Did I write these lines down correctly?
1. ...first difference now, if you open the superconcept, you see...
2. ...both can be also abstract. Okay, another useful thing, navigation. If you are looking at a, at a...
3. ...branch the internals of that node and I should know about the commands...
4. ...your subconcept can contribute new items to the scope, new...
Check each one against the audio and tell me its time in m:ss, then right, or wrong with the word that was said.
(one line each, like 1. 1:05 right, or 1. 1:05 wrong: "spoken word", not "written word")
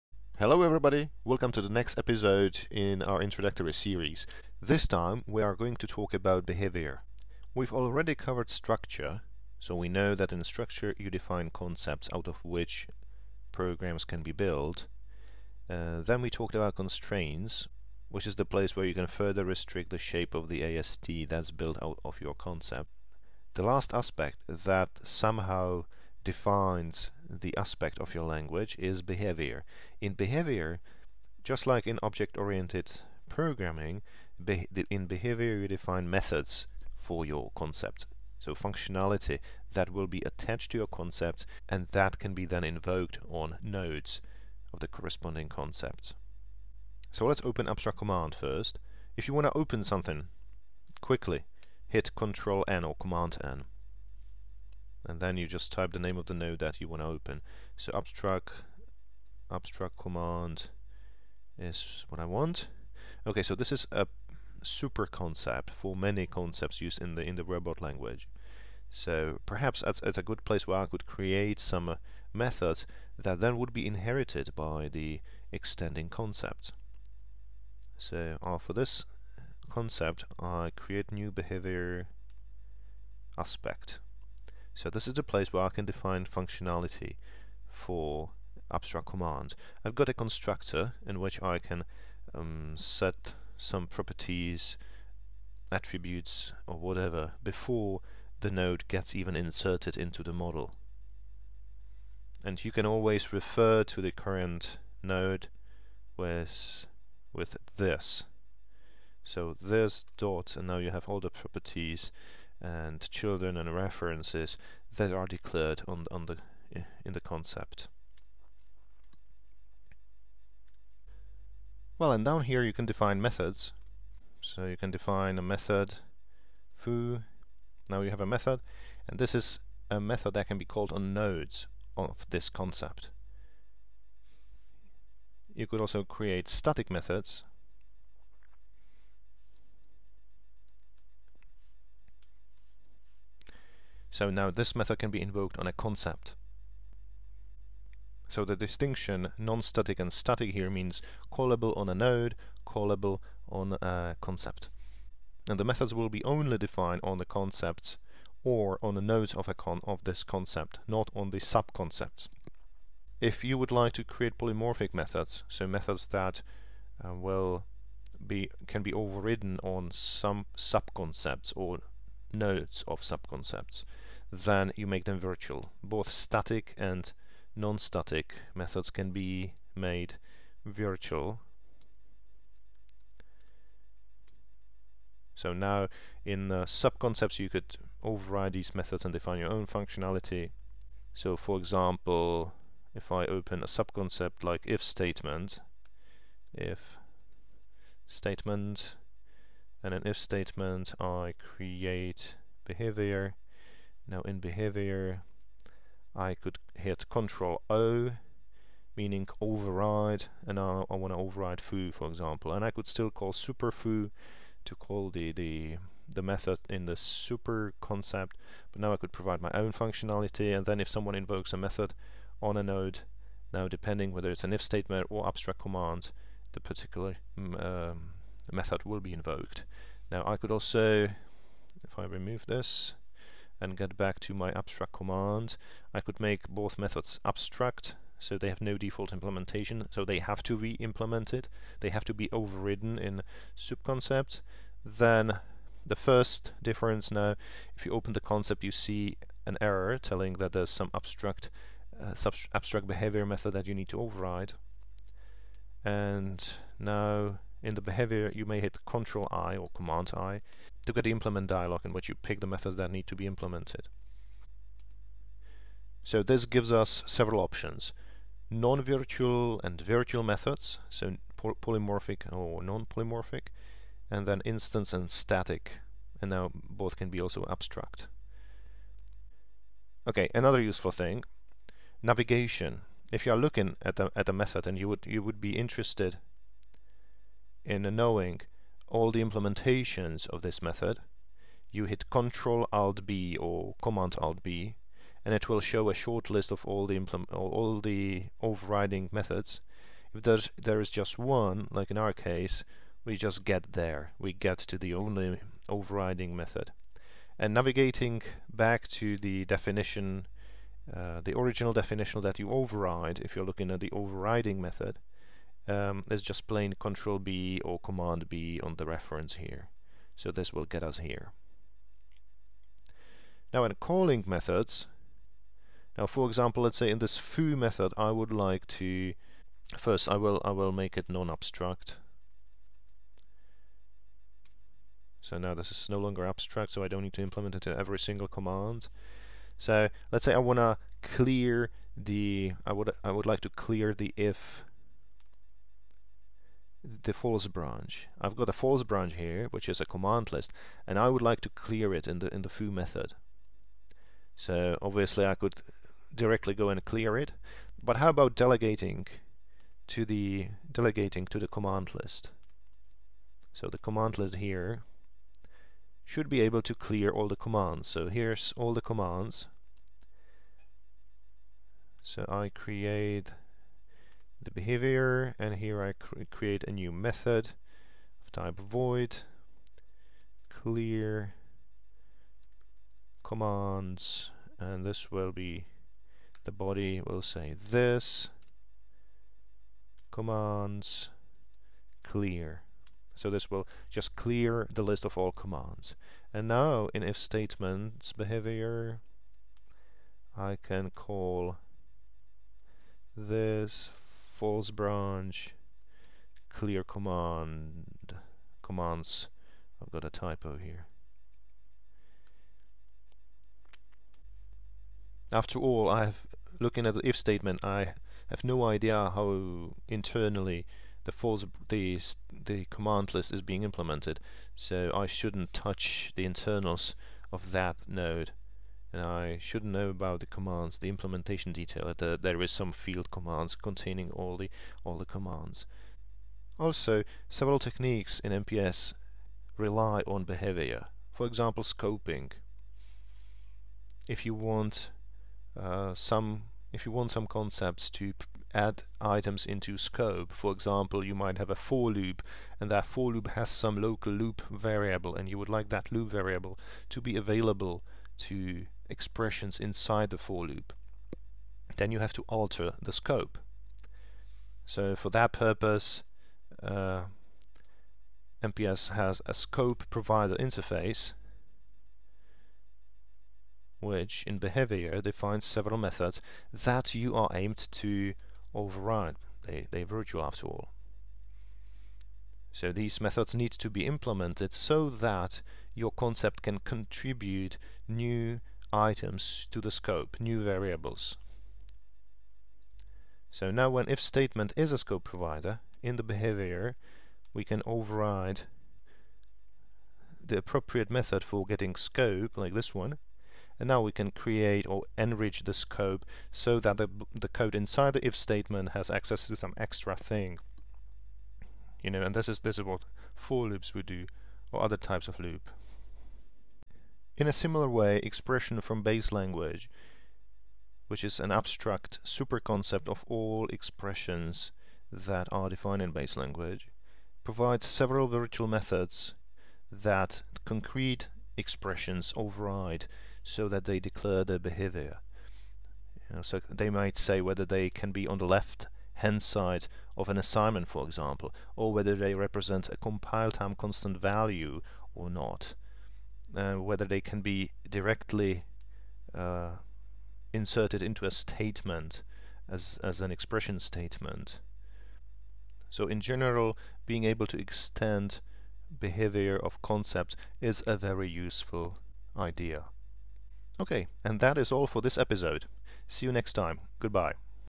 1. 4:05 wrong: "concept", not "superconcept"
2. 4:36 right
3. 7:05 wrong: "touch", not "branch"
4. 8:05 wrong: "concept", not "subconcept".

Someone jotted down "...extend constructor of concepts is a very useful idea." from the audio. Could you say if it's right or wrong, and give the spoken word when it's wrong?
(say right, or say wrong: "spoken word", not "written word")
wrong: "behavior", not "constructor".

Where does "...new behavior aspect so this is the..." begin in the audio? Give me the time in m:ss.
1:21.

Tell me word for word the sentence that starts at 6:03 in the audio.
So the command list here should be able to clear all the commands.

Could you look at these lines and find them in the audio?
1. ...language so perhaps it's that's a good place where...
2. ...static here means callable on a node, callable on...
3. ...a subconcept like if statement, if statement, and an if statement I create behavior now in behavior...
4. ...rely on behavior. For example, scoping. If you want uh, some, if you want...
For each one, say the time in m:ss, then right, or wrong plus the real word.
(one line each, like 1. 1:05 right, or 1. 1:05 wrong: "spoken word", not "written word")
1. 1:07 right
2. 2:30 right
3. 3:13 right
4. 7:19 right.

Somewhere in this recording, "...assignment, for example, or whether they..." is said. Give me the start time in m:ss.
9:00.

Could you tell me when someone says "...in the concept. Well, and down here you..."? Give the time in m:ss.
1:57.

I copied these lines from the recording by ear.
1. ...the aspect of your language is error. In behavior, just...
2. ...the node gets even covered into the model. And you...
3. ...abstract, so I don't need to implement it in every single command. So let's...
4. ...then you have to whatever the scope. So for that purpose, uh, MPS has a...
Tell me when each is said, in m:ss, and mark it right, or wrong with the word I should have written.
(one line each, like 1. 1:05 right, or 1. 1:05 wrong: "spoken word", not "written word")
1. 0:27 wrong: "behavior", not "error"
2. 1:38 wrong: "inserted", not "covered"
3. 5:36 right
4. 7:41 wrong: "alter", not "whatever".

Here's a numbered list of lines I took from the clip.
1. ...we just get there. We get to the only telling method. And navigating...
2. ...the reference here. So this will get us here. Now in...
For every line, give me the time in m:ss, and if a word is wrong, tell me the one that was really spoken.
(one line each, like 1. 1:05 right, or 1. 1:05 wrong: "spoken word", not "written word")
1. 5:03 wrong: "overriding", not "telling"
2. 5:18 right.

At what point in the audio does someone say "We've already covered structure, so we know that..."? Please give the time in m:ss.
0:07.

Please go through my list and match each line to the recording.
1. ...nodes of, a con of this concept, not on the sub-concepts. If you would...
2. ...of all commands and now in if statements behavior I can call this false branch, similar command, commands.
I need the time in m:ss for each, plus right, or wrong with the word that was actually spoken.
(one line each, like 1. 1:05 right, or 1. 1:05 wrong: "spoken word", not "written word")
1. 2:39 right
2. 6:35 wrong: "clear", not "similar".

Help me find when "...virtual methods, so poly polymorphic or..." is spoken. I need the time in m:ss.
4:29.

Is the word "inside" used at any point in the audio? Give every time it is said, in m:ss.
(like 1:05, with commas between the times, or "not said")
7:39, 8:27.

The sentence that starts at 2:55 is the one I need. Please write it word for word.
Both static and non-static methods can be made virtual.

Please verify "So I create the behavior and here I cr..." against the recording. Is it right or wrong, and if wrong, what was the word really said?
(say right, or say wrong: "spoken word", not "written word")
right.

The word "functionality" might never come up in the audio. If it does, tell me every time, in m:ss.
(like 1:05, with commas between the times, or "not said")
0:38, 1:26, 3:09, 3:39.